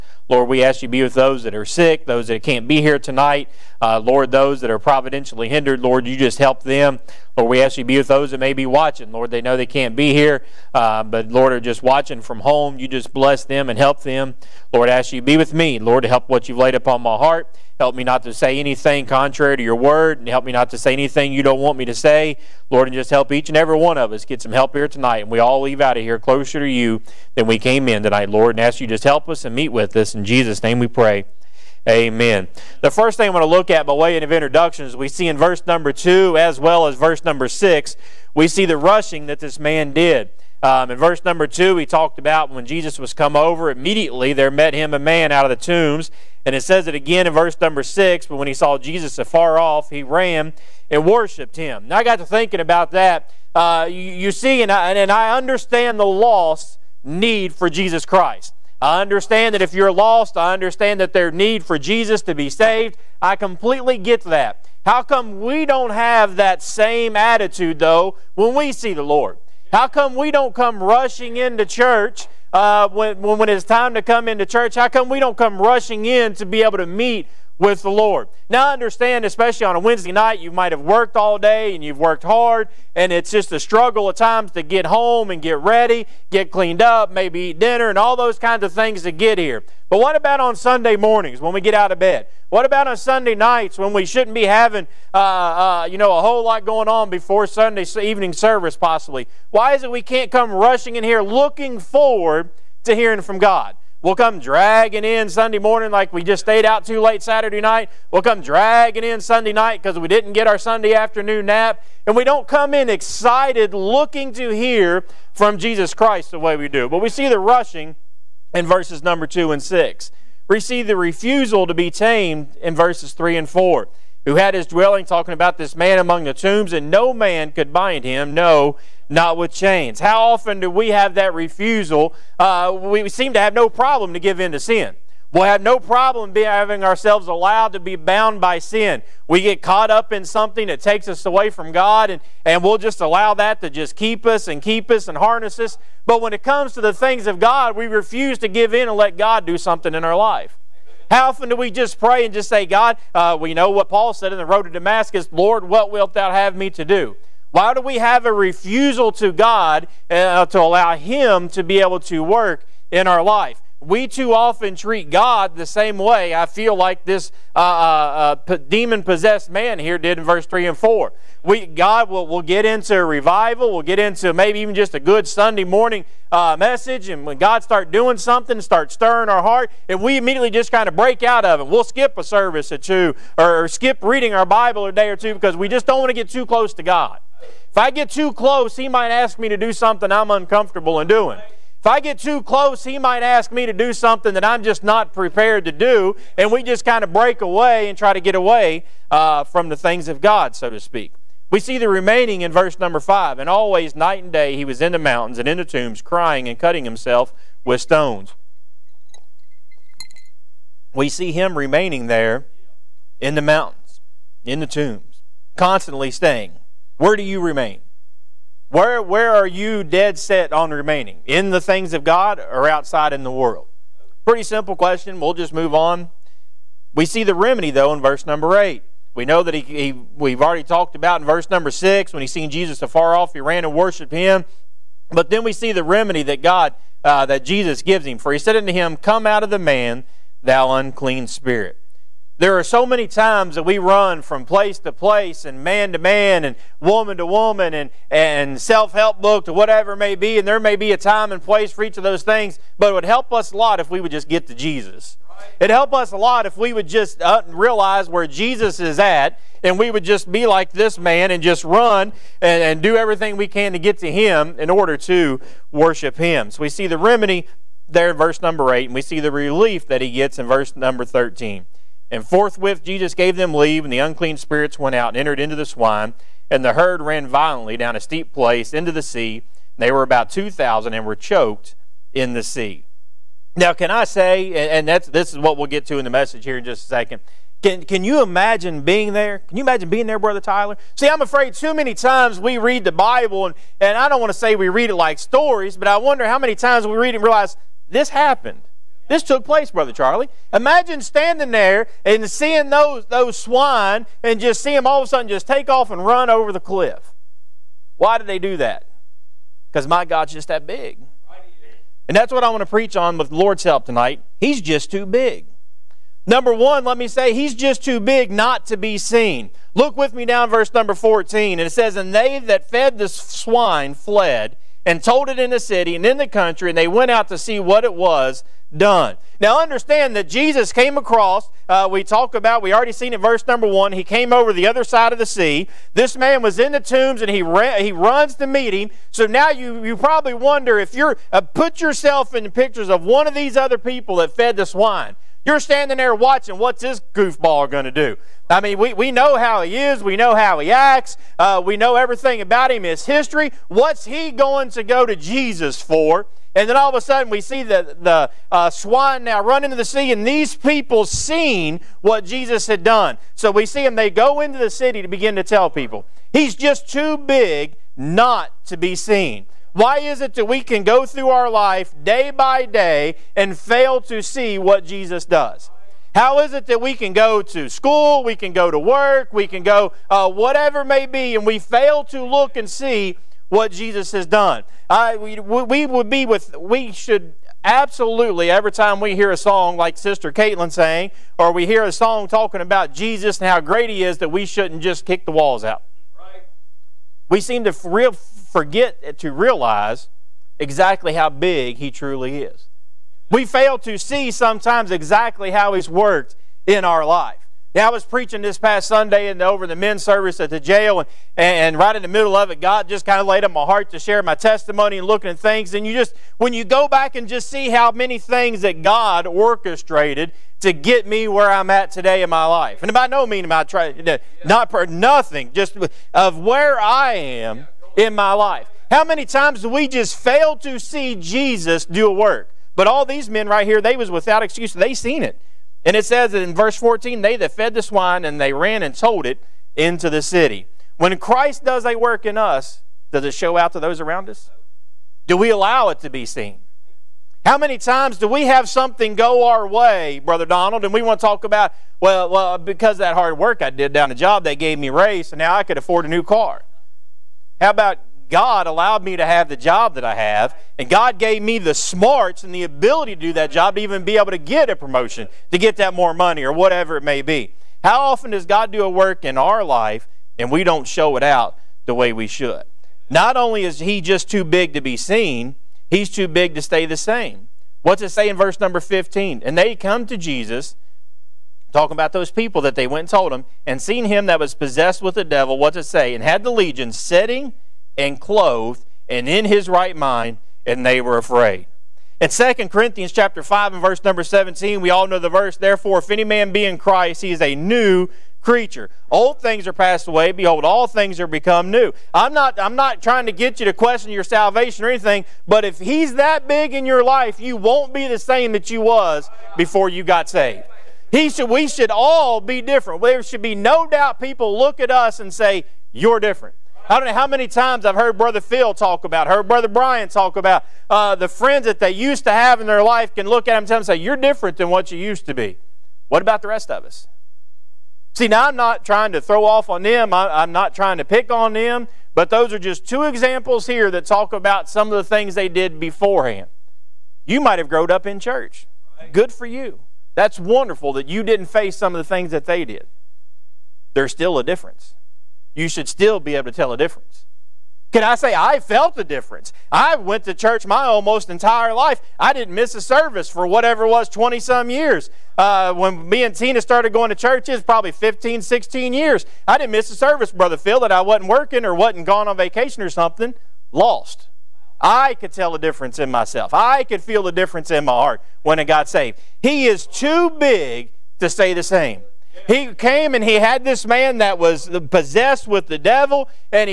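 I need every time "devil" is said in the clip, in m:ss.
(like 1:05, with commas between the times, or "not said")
8:05, 9:35.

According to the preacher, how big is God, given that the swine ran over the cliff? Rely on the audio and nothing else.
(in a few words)
Just that big.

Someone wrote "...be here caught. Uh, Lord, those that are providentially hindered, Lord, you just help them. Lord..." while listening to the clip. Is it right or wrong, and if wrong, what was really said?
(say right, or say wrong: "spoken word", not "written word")
wrong: "tonight", not "caught".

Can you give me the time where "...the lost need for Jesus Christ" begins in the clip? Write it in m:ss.
0:55.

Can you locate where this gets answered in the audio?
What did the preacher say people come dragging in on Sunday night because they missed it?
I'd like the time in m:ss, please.
1:50.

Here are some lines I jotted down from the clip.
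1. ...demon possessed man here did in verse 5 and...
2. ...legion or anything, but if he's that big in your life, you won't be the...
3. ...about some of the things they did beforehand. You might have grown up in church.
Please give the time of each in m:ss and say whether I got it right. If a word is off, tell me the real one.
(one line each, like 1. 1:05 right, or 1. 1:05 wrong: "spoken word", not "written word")
1. 2:48 wrong: "3", not "5"
2. 8:24 wrong: "salvation", not "legion"
3. 8:54 right.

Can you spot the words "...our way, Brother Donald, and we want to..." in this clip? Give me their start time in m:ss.
7:29.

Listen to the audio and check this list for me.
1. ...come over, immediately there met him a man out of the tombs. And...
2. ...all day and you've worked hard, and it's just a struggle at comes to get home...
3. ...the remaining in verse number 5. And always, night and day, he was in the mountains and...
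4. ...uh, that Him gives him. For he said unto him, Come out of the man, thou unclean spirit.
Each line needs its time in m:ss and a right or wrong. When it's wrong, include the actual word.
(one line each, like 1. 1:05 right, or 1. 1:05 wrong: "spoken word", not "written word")
1. 0:43 right
2. 1:21 wrong: "times", not "comes"
3. 3:21 right
4. 3:57 wrong: "Jesus", not "Him".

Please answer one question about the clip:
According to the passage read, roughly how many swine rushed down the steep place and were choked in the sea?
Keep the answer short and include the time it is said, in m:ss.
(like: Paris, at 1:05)
2,000, at 4:40.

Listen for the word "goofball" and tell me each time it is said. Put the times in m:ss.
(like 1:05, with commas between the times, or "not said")
5:47.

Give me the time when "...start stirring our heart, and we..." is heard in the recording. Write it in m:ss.
2:58.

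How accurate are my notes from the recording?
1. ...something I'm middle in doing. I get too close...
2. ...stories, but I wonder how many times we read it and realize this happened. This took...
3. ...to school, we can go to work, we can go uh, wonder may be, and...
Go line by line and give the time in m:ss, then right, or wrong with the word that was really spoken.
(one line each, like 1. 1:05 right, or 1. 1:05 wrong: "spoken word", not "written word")
1. 3:09 wrong: "uncomfortable", not "middle"
2. 4:55 right
3. 6:17 wrong: "whatever", not "wonder".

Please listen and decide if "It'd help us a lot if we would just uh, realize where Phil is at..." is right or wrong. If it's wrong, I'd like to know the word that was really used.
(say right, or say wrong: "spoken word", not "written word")
wrong: "Jesus", not "Phil".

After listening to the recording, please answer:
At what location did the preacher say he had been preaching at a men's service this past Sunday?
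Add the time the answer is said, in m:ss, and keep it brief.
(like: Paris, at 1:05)
The jail, at 6:50.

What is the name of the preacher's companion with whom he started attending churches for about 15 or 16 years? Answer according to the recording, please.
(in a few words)
Tina.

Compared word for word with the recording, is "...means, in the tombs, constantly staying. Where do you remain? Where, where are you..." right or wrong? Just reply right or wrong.
wrong.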